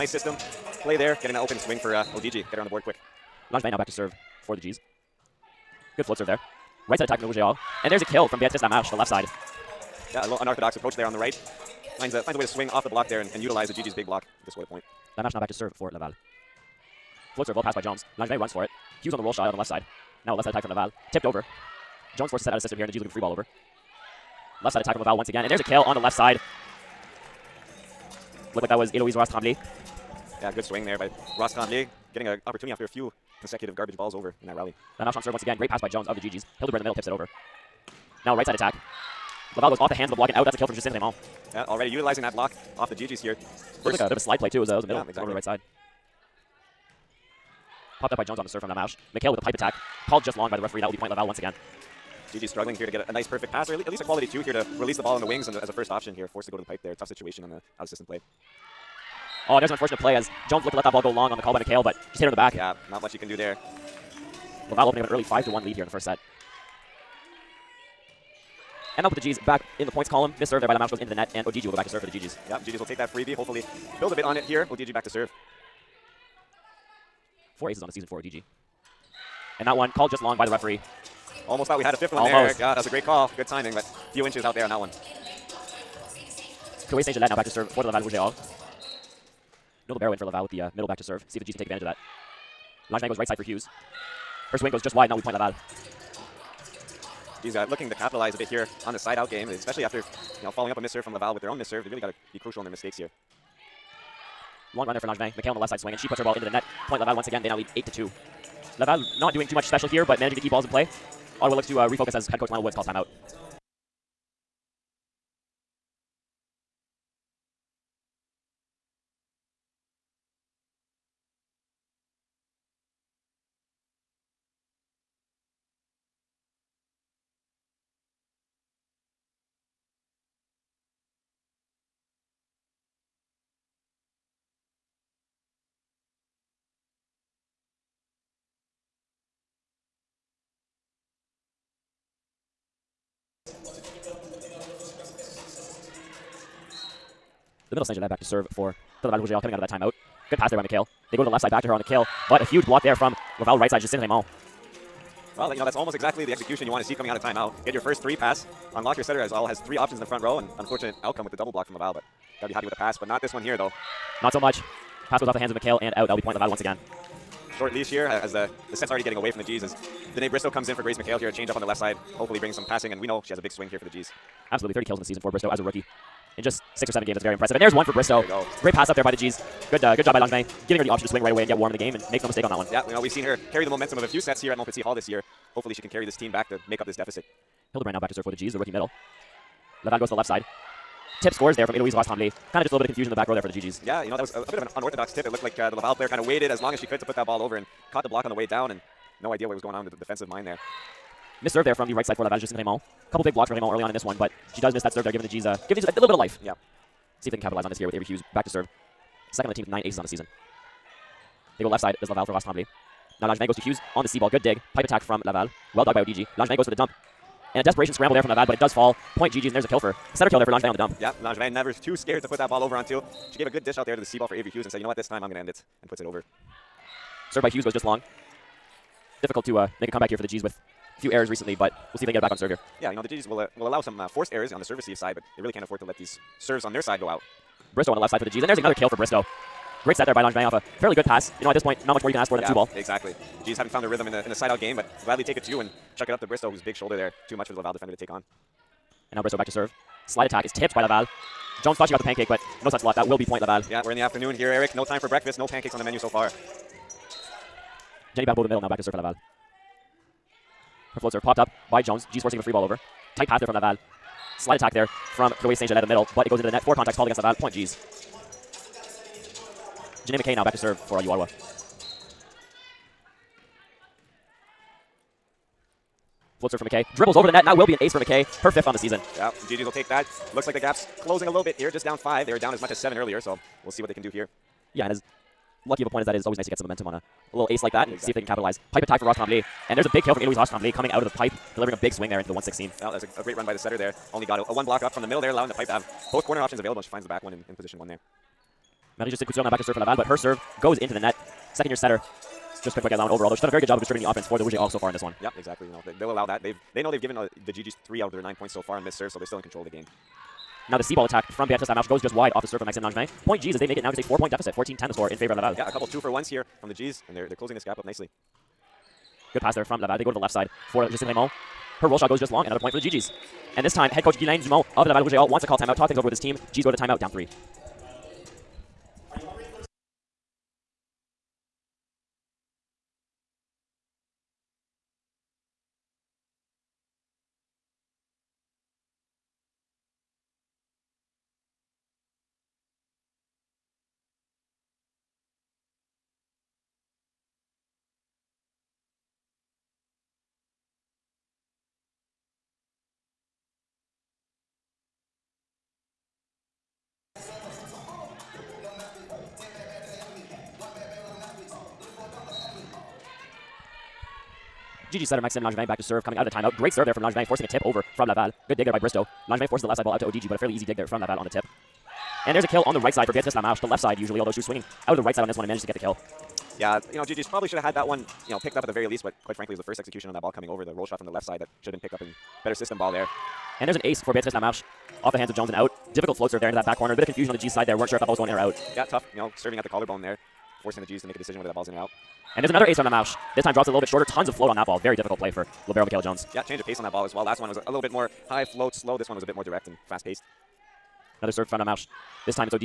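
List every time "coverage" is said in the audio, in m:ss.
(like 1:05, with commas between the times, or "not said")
not said.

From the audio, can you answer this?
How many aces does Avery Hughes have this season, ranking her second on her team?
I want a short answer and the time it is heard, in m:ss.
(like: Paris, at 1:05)
9, at 3:29.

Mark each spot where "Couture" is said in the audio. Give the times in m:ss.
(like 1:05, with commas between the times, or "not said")
4:59.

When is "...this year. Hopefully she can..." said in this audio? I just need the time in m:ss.
3:04.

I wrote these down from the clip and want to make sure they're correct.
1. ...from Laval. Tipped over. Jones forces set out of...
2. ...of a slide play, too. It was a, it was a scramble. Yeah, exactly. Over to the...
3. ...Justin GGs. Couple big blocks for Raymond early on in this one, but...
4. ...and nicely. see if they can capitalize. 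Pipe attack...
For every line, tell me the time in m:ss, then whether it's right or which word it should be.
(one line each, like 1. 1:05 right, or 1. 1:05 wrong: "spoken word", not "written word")
1. 0:20 right
2. 0:44 wrong: "middle", not "scramble"
3. 3:22 wrong: "Raymond", not "GGs"
4. 4:47 wrong: "exactly", not "nicely".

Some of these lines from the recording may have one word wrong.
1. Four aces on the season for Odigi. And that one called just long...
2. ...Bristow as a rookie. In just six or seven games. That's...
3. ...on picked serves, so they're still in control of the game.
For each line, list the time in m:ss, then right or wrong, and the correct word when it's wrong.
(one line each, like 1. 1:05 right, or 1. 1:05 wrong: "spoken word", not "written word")
1. 1:17 right
2. 2:55 right
3. 5:08 wrong: "missed", not "picked".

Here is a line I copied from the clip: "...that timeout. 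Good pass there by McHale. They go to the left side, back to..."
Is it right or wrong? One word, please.
right.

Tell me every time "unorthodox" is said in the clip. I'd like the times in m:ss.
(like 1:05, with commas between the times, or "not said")
0:10, 3:14.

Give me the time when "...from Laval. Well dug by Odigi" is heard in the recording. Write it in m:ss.
3:35.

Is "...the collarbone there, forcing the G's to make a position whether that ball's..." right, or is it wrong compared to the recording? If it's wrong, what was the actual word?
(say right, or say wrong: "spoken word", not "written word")
wrong: "decision", not "position".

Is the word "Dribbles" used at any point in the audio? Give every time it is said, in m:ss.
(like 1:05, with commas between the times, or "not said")
4:36.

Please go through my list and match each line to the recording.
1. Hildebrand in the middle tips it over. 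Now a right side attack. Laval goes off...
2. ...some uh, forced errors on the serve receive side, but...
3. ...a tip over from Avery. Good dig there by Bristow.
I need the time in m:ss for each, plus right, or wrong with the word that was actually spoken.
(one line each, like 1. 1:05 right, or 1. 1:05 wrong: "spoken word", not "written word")
1. 0:36 right
2. 3:53 right
3. 6:07 wrong: "Laval", not "Avery".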